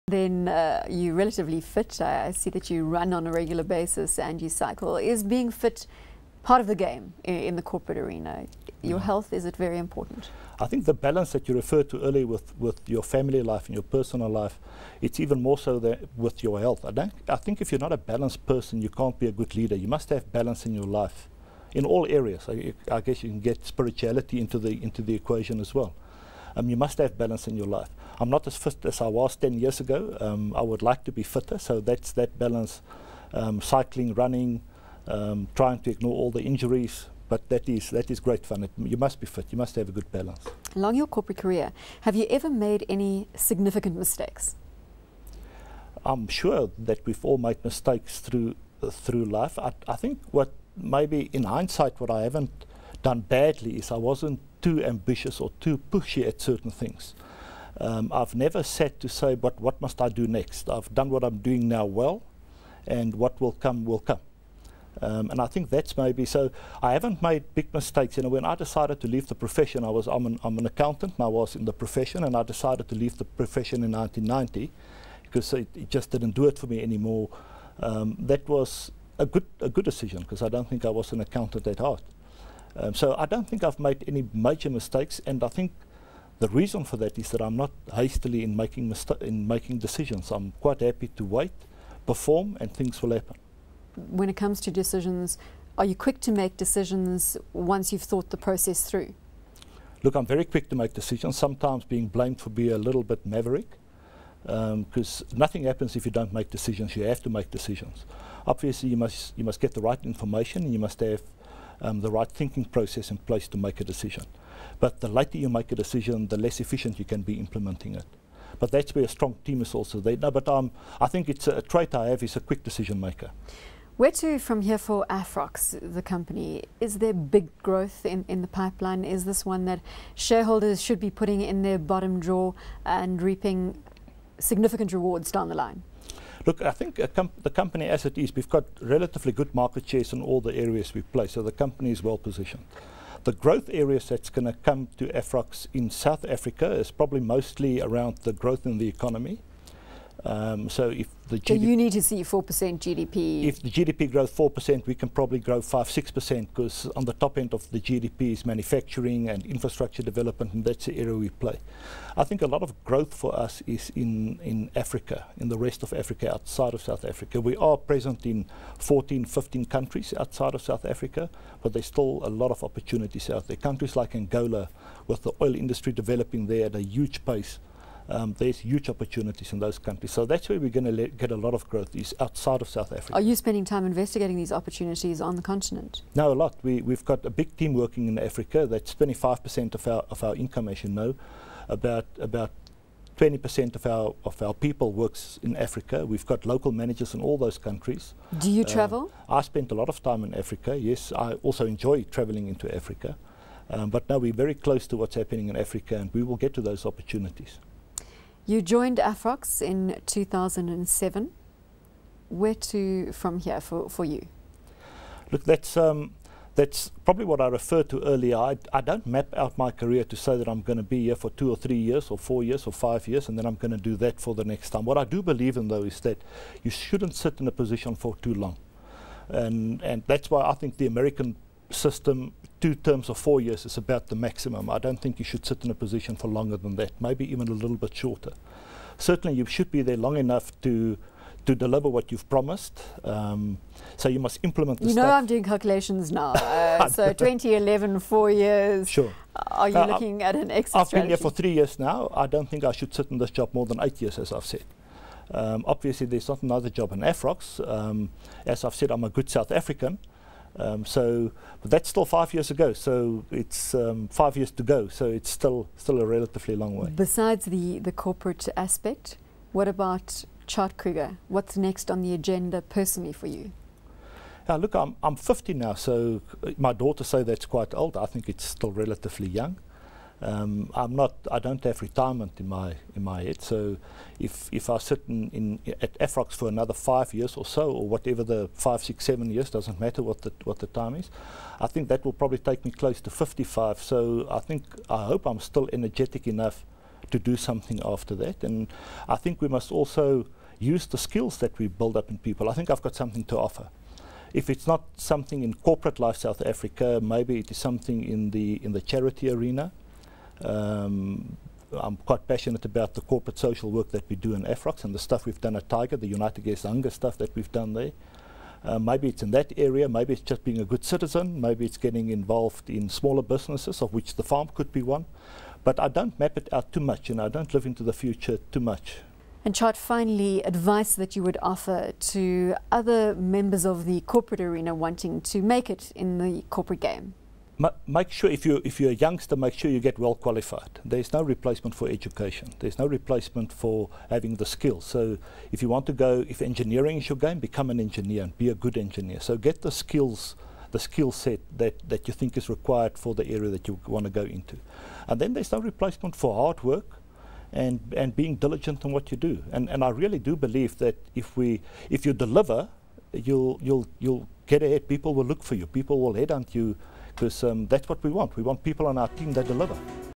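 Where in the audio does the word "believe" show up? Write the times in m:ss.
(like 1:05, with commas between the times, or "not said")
3:45, 6:00.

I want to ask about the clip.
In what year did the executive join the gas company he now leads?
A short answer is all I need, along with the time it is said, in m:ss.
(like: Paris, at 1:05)
2007, at 3:30.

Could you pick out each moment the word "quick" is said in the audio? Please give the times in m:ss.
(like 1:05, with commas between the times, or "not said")
1:35, 1:40, 2:02.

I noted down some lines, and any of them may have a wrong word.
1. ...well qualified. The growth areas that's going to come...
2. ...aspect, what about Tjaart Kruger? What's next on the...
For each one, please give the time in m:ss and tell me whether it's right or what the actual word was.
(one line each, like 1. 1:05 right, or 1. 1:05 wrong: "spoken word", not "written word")
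1. 2:22 wrong: "positioned", not "qualified"
2. 4:28 right.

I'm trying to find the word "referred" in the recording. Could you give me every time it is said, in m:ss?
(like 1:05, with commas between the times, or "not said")
0:11, 3:37.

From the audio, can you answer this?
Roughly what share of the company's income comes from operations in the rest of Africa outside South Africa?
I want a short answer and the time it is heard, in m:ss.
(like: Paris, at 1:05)
25%, at 3:08.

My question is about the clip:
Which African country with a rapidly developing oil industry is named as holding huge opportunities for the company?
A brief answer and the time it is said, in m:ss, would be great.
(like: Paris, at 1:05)
Angola, at 2:54.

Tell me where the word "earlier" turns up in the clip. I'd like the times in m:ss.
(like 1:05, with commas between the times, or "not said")
0:12, 3:38.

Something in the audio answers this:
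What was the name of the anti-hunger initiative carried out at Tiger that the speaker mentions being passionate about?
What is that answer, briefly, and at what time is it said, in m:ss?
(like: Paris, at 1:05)
United Against Hunger, at 5:16.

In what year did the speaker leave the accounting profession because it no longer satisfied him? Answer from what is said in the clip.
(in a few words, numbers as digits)
1990.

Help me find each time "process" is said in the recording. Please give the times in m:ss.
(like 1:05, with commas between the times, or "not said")
1:38, 1:52.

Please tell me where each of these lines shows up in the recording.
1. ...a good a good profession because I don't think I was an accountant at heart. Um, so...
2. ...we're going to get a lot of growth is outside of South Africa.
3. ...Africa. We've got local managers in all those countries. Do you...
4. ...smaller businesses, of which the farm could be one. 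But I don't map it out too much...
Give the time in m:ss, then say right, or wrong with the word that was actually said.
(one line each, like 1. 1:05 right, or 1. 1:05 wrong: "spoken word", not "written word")
1. 1:19 wrong: "decision", not "profession"
2. 3:00 right
3. 3:15 right
4. 5:22 right.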